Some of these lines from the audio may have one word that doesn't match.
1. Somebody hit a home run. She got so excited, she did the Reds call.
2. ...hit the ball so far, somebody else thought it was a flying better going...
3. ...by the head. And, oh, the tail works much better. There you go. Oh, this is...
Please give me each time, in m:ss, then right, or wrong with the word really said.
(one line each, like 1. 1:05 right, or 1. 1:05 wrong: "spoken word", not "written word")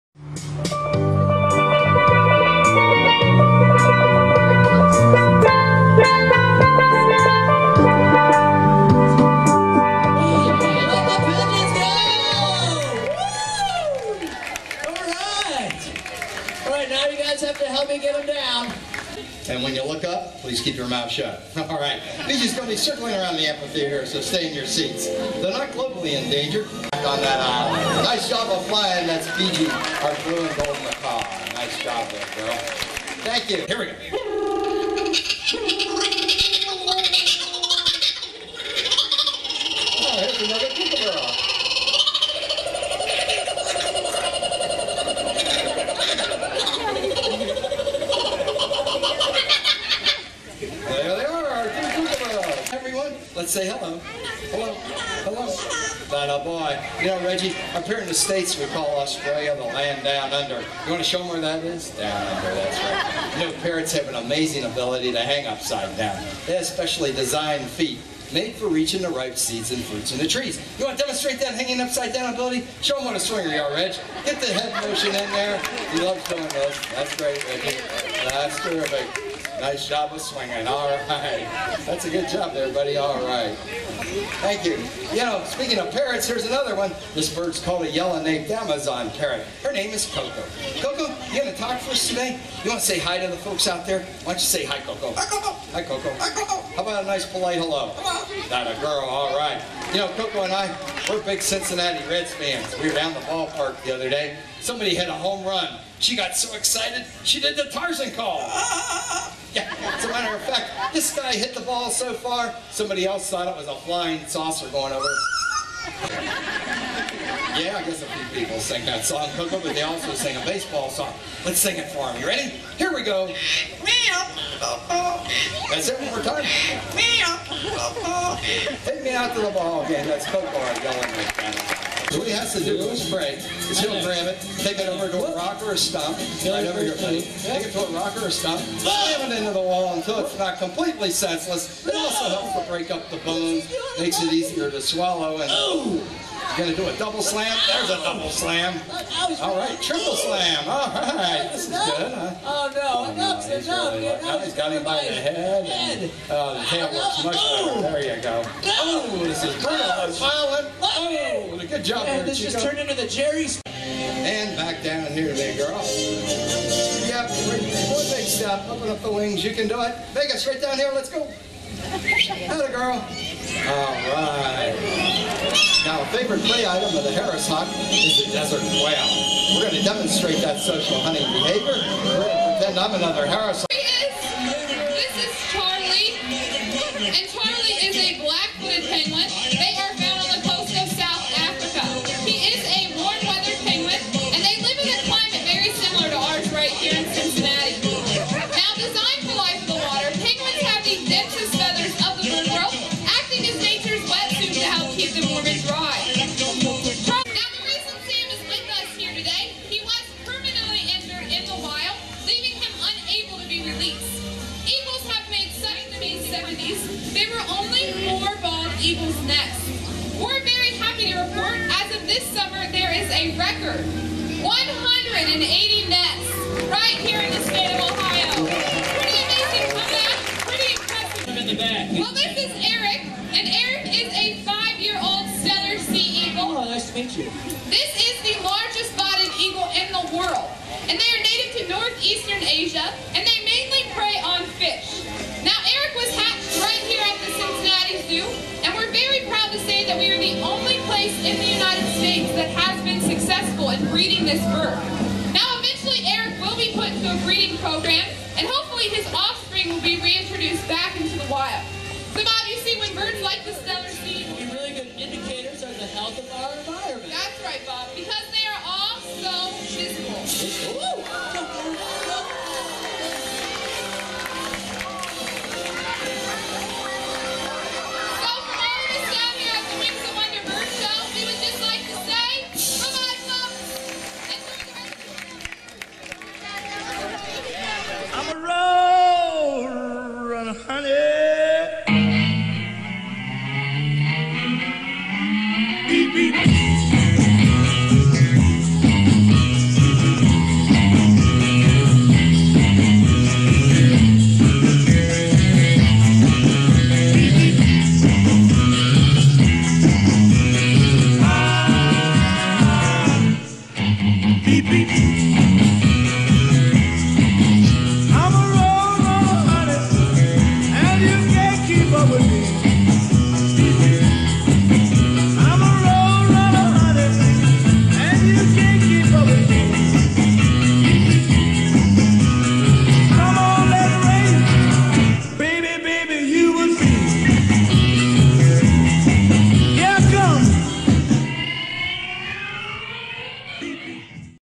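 1. 1:44 wrong: "Tarzan", not "Reds"
2. 1:51 wrong: "saucer", not "better"
3. 2:34 right.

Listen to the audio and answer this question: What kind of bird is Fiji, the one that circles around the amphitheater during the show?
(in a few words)
blue and gold macaw.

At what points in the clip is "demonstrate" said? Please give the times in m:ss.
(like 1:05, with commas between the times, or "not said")
1:11, 2:59.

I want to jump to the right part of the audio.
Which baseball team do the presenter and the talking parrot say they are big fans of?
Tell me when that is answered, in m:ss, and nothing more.
1:41.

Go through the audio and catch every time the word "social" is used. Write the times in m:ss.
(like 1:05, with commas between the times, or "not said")
3:00.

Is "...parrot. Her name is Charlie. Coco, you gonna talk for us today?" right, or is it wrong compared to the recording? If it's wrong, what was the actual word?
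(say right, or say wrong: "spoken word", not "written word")
wrong: "Coco", not "Charlie".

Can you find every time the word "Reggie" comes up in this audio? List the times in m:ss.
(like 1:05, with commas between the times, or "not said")
0:57, 1:17.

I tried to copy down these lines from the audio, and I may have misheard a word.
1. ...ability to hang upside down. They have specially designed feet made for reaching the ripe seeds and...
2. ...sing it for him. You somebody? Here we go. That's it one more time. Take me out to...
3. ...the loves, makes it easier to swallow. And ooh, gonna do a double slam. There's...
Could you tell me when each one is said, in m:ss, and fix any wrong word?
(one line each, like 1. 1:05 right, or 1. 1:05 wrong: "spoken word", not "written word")
1. 1:04 right
2. 2:01 wrong: "ready", not "somebody"
3. 2:23 wrong: "bones", not "loves".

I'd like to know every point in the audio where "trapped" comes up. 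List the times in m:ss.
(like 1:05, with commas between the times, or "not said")
not said.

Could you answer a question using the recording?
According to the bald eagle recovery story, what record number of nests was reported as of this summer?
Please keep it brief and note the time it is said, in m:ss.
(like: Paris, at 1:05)
180, at 3:44.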